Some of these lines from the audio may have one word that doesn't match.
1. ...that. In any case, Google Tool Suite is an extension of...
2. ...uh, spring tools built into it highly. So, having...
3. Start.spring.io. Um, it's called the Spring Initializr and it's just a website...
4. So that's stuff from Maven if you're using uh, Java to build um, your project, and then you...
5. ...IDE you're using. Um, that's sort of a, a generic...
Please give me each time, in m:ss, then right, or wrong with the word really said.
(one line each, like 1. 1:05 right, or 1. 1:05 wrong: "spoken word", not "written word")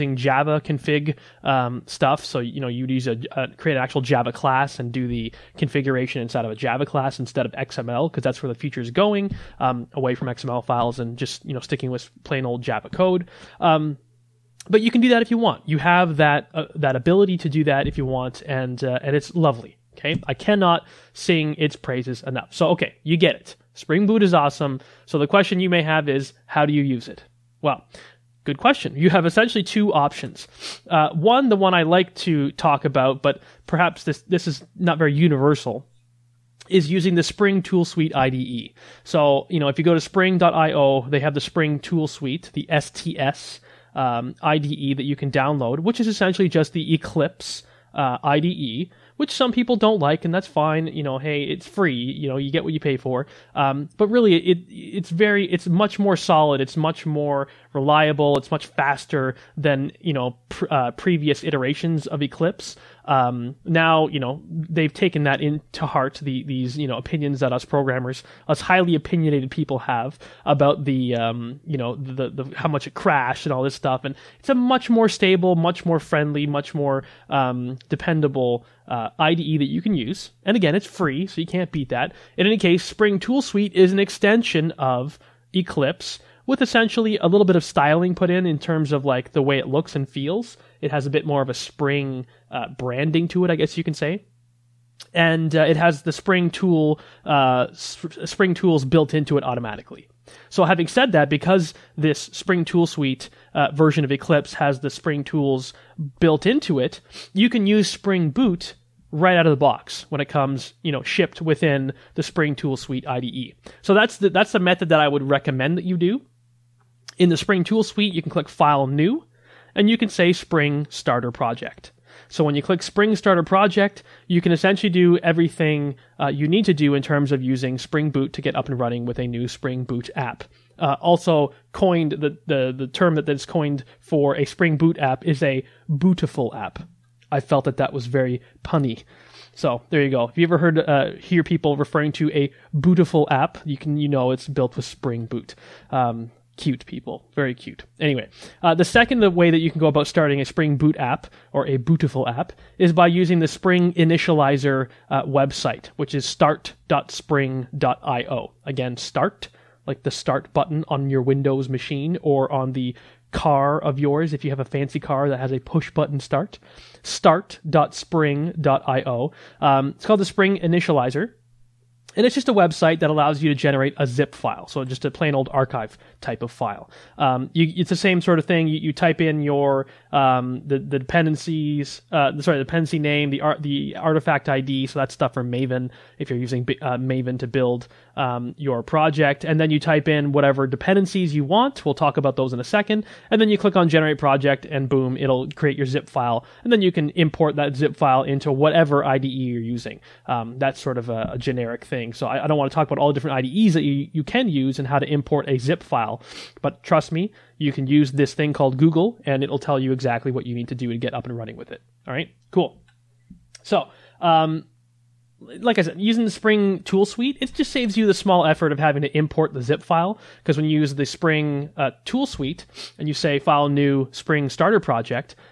1. 1:21 wrong: "Spring", not "Google"
2. 1:37 wrong: "automatically", not "highly"
3. 2:47 right
4. 3:04 wrong: "Maven", not "Java"
5. 3:19 right.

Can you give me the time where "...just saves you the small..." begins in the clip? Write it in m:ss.
3:37.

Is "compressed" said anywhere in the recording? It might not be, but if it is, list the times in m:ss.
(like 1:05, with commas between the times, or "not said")
not said.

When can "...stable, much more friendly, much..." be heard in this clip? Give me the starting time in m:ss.
1:15.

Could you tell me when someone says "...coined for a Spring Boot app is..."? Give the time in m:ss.
2:13.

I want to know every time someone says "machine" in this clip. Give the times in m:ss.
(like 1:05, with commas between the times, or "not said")
2:41.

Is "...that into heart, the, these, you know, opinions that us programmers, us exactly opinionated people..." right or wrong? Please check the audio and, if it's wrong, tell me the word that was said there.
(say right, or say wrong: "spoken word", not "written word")
wrong: "highly", not "exactly".